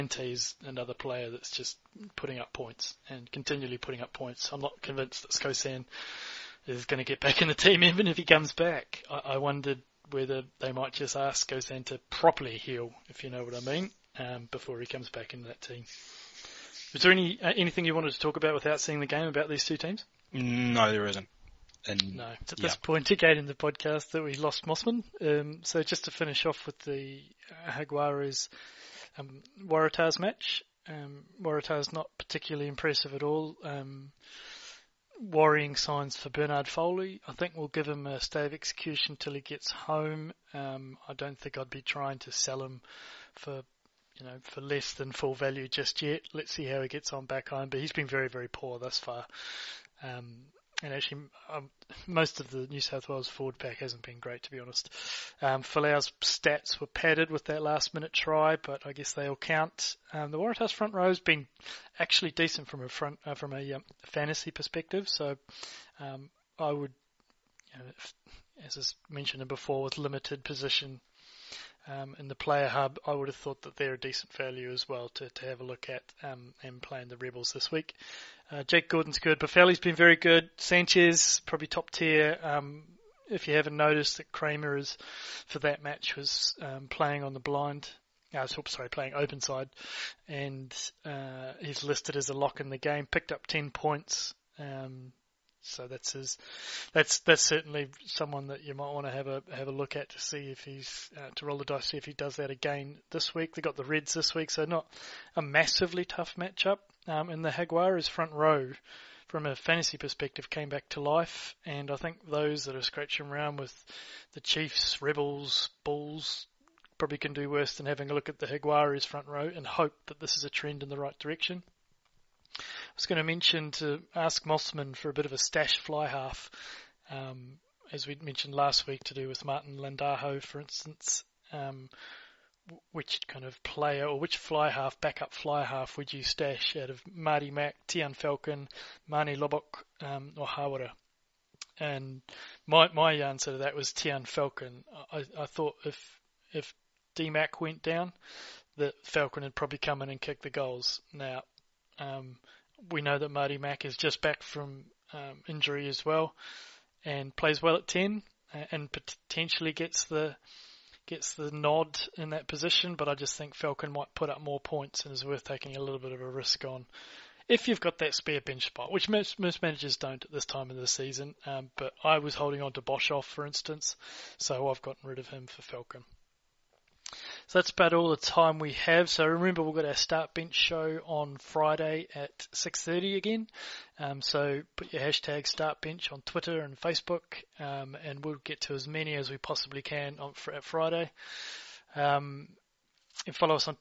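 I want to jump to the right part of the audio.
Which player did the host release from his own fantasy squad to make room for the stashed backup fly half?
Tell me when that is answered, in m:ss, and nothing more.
2:52.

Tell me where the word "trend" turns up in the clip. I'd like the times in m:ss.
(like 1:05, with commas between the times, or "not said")
2:00.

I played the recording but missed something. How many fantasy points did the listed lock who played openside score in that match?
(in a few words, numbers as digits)
10.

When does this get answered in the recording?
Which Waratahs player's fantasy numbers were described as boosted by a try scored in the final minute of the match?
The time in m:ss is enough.
0:55.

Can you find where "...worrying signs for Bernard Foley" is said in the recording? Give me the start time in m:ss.
0:35.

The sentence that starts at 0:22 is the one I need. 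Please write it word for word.
this point again in the podcast that we lost Mossman.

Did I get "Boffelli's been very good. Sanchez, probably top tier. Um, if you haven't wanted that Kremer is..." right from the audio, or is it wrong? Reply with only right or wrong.
wrong.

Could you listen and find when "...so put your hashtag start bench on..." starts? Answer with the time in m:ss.
3:04.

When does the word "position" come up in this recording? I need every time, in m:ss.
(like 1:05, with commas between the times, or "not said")
1:10, 2:42.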